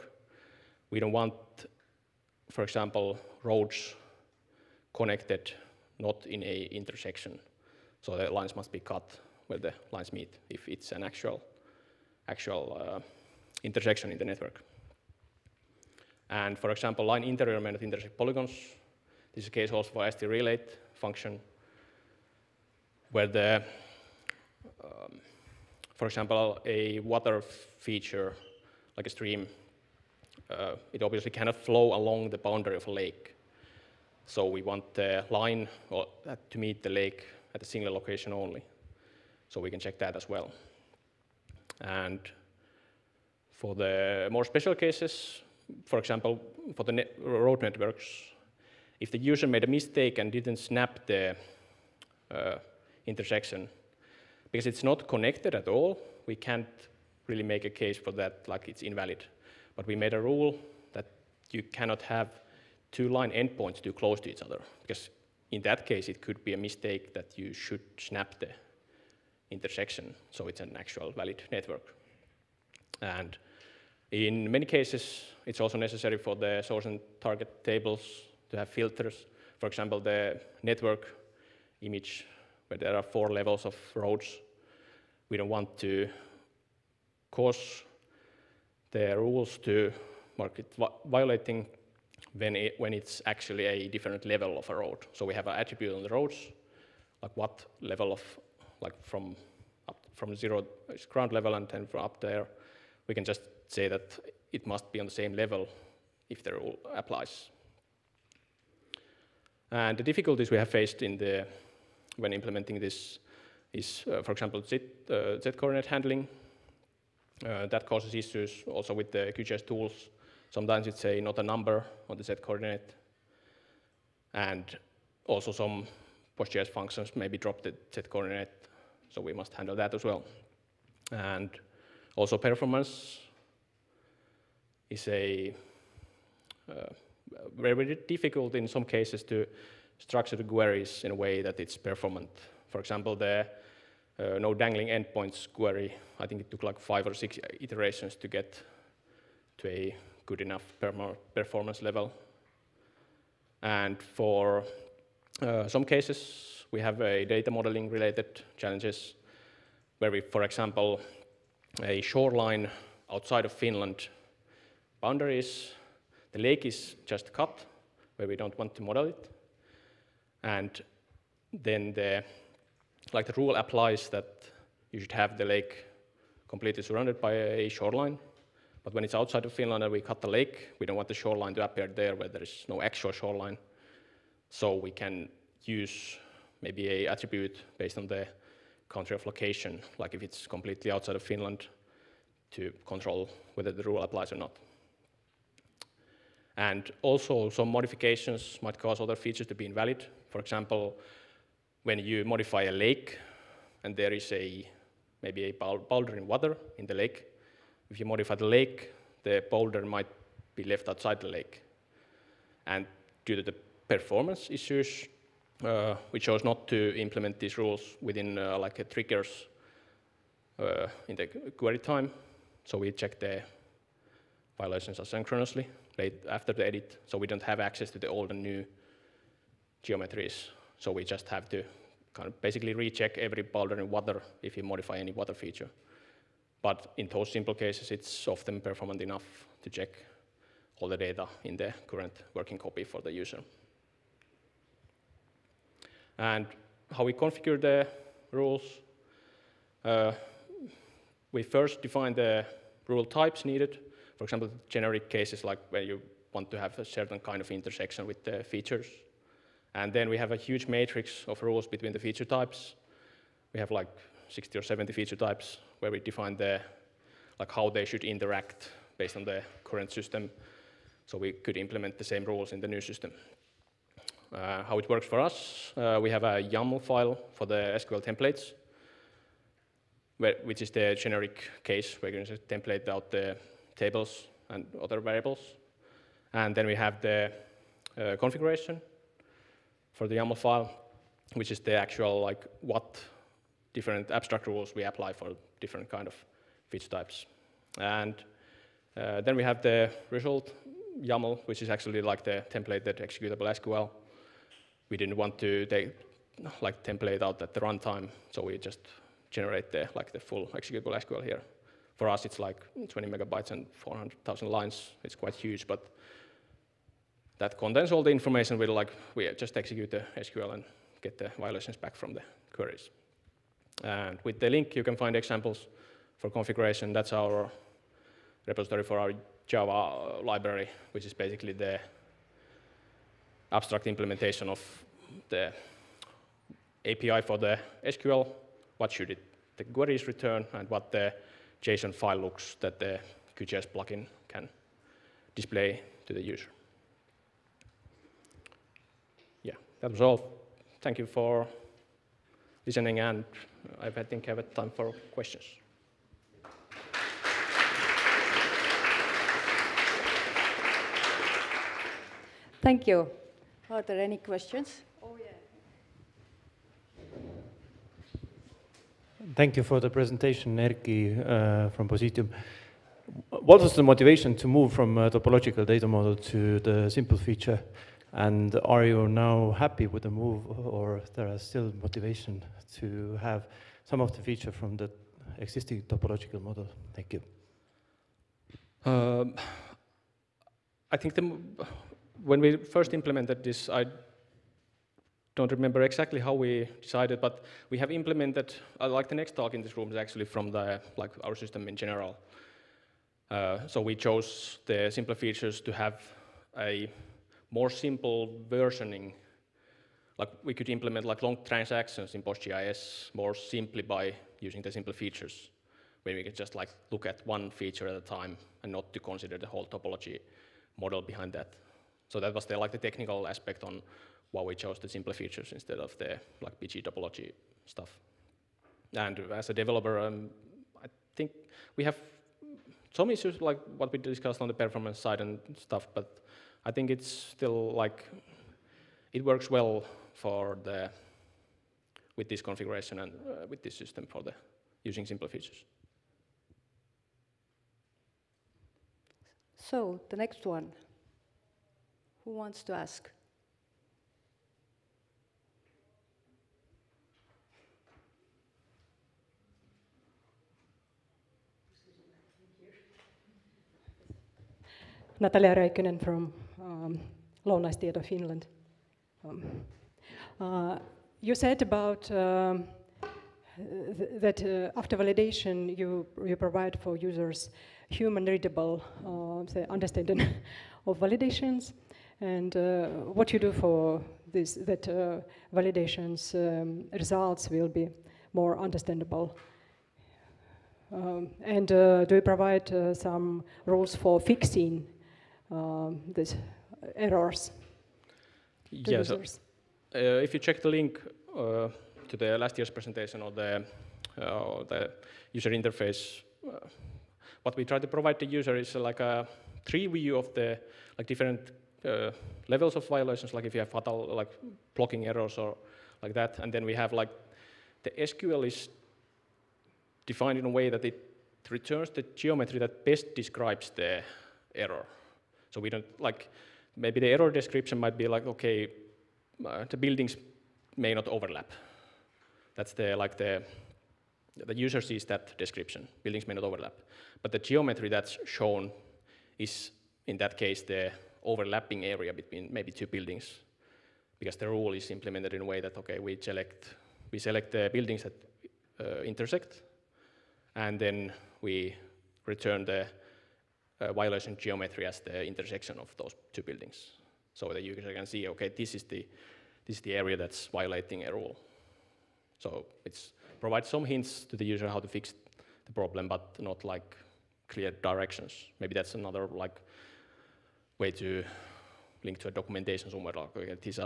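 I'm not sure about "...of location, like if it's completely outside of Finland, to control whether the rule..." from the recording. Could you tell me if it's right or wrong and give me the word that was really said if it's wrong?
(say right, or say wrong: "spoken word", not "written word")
right.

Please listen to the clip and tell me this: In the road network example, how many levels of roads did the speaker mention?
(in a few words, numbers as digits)
4.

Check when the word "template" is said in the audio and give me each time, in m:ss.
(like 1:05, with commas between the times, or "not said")
4:38, 4:42, 5:02, 5:06.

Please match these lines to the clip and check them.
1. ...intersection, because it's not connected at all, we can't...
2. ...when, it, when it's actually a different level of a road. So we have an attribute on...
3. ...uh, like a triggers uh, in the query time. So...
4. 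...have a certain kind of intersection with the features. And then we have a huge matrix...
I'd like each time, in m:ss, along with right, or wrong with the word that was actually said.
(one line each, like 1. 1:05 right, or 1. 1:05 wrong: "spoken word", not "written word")
1. 0:53 right
2. 1:32 right
3. 3:38 right
4. 4:16 right.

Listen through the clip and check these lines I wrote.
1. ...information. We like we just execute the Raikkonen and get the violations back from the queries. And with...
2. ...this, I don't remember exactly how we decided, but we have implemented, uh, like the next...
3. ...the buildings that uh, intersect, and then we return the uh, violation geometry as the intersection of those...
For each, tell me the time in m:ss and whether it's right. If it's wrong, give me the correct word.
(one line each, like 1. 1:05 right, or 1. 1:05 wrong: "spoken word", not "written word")
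1. 5:18 wrong: "SQL", not "Raikkonen"
2. 6:33 right
3. 9:07 right.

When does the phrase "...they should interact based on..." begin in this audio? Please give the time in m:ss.
4:27.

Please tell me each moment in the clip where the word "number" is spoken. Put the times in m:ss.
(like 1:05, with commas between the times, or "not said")
2:01.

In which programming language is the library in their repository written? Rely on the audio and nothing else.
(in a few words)
Java.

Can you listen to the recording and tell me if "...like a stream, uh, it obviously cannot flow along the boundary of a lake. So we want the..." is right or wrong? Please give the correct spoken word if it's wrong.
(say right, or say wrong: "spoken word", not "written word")
right.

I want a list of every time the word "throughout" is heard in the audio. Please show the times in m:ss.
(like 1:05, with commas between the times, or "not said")
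not said.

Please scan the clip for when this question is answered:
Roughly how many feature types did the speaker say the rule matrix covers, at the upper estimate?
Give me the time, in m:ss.
4:24.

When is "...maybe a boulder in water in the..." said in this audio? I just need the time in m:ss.
3:25.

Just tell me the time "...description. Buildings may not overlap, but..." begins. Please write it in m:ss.
8:55.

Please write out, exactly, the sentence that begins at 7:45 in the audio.
Natalia Raikkonen from um, of Finland.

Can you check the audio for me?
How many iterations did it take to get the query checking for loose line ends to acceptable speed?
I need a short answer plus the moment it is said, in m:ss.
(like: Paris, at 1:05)
5 or 6, at 2:26.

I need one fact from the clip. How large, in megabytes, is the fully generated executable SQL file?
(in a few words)
20 megabytes.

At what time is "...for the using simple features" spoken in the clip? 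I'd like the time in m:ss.
7:24.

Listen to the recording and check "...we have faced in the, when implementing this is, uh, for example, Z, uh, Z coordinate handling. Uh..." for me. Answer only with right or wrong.
right.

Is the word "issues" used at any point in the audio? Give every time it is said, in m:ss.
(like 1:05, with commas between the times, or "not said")
1:58, 3:34, 7:13.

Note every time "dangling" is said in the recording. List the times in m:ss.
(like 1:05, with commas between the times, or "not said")
2:24.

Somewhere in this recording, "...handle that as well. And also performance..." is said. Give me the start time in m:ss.
2:09.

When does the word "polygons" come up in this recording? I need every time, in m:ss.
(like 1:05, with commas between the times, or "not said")
0:18.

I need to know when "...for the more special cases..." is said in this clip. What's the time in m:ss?
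0:43.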